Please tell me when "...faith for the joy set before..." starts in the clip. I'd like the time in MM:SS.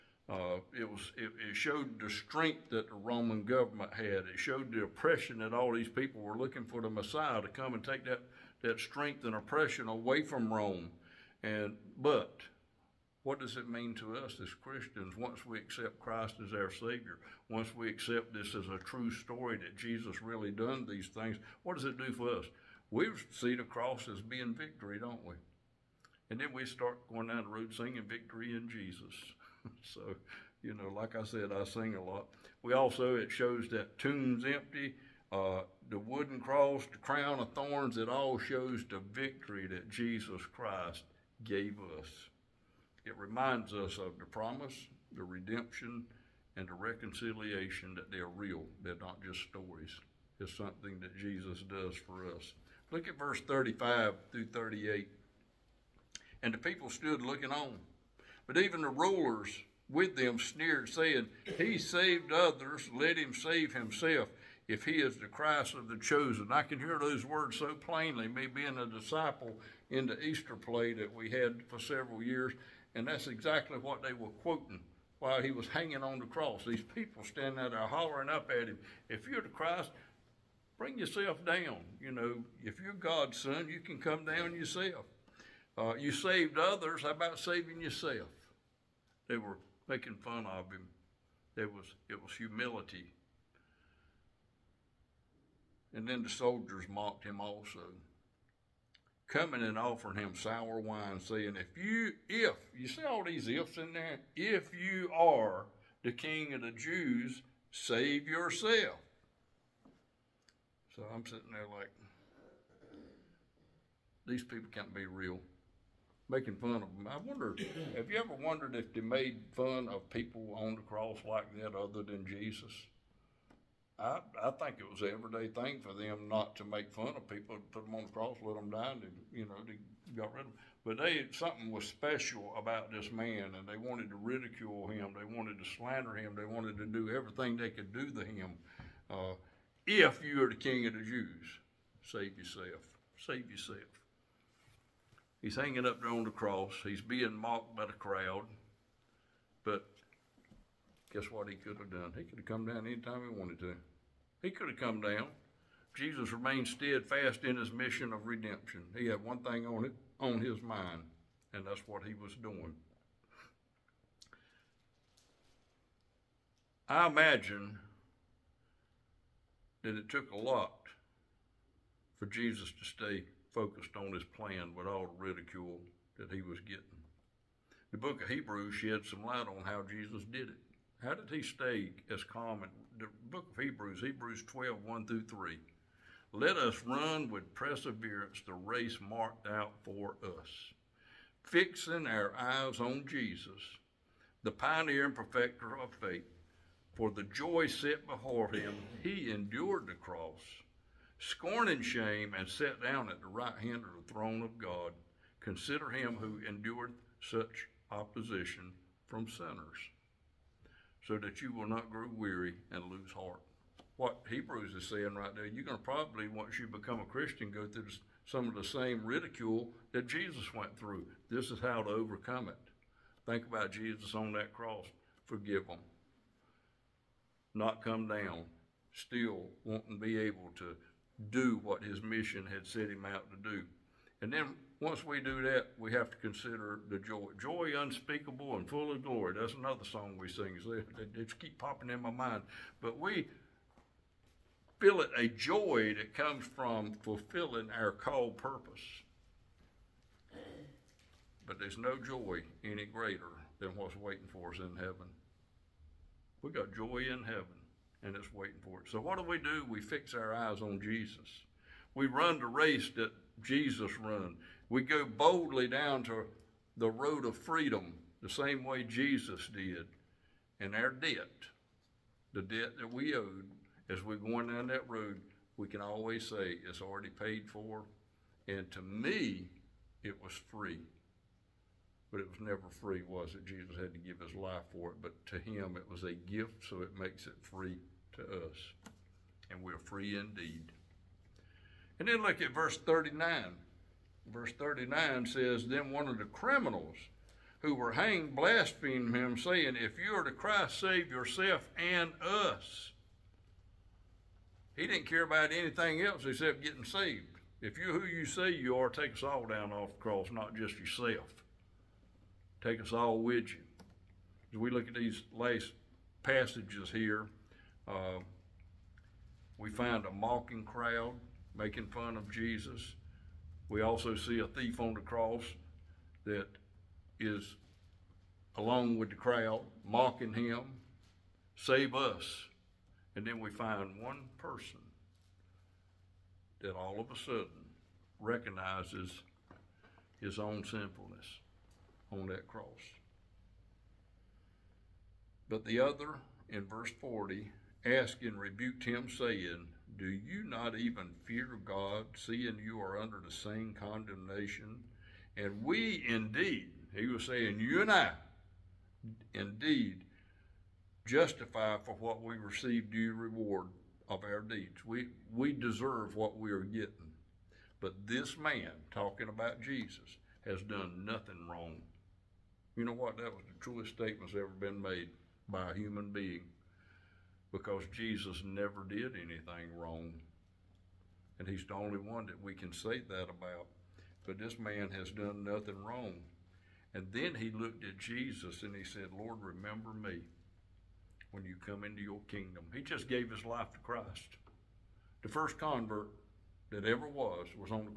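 03:15.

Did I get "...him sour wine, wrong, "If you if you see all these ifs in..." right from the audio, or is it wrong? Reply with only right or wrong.
wrong.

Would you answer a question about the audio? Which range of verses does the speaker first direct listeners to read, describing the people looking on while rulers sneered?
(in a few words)
35 through 38.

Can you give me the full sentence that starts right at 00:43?
It reminds us of the promise, the redemption, and the reconciliation that they're real.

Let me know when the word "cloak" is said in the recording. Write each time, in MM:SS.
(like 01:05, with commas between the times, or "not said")
not said.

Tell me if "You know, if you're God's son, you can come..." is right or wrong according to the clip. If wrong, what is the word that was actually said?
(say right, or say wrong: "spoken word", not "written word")
right.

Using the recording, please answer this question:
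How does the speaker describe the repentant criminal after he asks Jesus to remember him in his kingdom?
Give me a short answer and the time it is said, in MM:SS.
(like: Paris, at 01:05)
The first convert, at 06:35.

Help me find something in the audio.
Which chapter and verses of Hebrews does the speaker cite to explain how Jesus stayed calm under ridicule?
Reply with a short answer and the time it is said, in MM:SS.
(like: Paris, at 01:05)
Hebrews 12:1-3, at 03:04.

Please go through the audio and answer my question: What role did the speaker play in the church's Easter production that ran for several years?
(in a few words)
A disciple.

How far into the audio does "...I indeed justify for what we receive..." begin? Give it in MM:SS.
05:57.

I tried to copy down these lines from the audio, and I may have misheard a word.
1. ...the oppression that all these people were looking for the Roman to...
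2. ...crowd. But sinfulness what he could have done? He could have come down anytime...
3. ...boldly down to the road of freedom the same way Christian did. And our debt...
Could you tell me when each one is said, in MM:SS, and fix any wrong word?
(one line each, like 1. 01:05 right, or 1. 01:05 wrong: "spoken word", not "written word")
1. 00:04 wrong: "Messiah", not "Roman"
2. 02:27 wrong: "guess", not "sinfulness"
3. 04:25 wrong: "Jesus", not "Christian".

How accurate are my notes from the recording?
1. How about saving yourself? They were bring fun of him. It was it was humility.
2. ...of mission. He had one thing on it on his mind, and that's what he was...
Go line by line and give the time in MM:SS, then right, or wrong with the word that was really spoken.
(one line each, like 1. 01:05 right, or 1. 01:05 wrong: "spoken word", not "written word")
1. 01:27 wrong: "making", not "bring"
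2. 02:38 wrong: "redemption", not "mission".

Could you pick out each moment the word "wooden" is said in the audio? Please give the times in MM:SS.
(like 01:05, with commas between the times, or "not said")
00:35.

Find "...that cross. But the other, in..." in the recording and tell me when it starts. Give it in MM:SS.
05:42.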